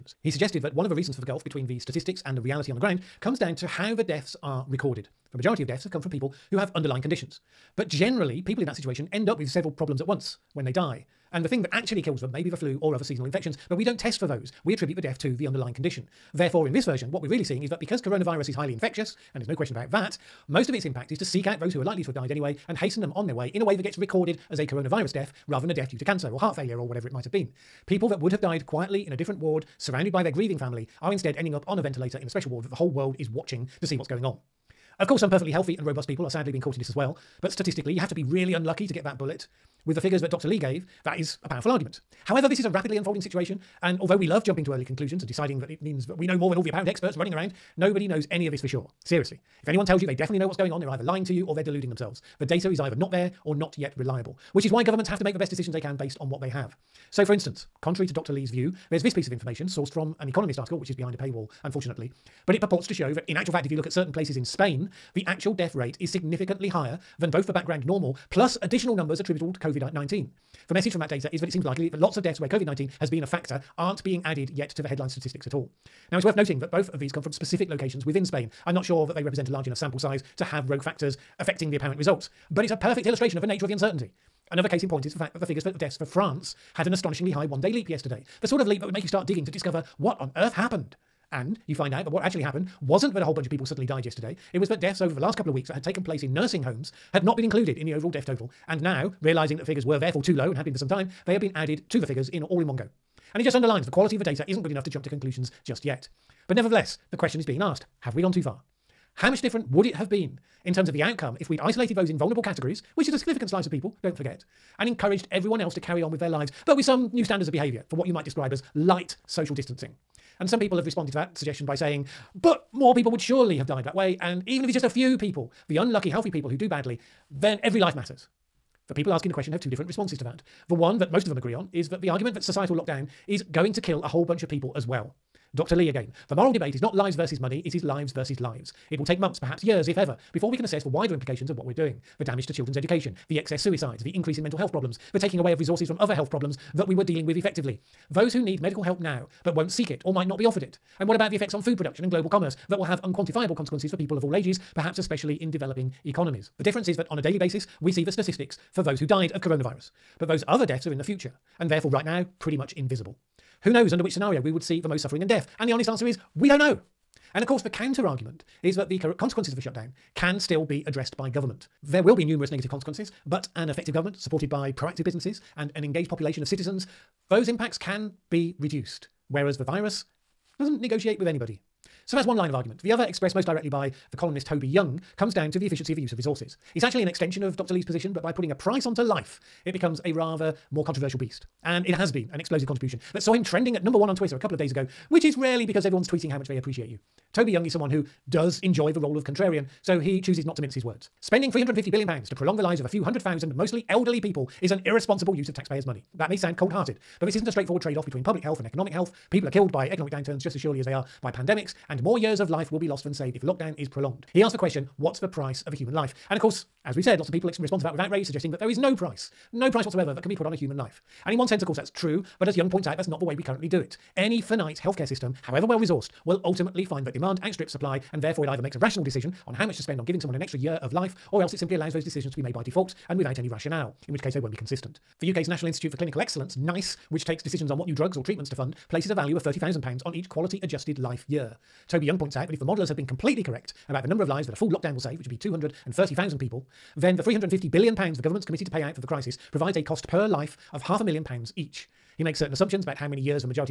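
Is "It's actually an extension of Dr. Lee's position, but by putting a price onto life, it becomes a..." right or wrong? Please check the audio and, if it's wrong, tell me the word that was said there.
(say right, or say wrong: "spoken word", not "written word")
right.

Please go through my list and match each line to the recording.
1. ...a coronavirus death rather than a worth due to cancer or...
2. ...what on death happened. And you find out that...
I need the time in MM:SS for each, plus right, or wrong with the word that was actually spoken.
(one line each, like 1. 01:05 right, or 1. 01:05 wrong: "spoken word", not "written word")
1. 00:24 wrong: "death", not "worth"
2. 01:29 wrong: "earth", not "death".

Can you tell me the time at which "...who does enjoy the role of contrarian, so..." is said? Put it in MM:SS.
03:17.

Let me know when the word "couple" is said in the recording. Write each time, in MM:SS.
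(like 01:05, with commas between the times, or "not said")
01:35, 03:14.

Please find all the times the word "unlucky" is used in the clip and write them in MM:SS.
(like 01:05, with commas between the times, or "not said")
00:38, 02:05.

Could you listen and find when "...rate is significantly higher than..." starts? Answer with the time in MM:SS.
01:05.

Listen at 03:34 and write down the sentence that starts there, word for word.
He asked the question what's the price of a human life?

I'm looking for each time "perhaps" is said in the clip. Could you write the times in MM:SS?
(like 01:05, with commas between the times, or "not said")
02:19, 02:34.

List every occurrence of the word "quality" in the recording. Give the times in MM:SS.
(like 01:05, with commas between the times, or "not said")
01:43, 04:00.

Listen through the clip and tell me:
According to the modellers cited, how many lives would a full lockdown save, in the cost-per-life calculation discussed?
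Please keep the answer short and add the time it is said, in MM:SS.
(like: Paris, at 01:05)
230,000, at 04:05.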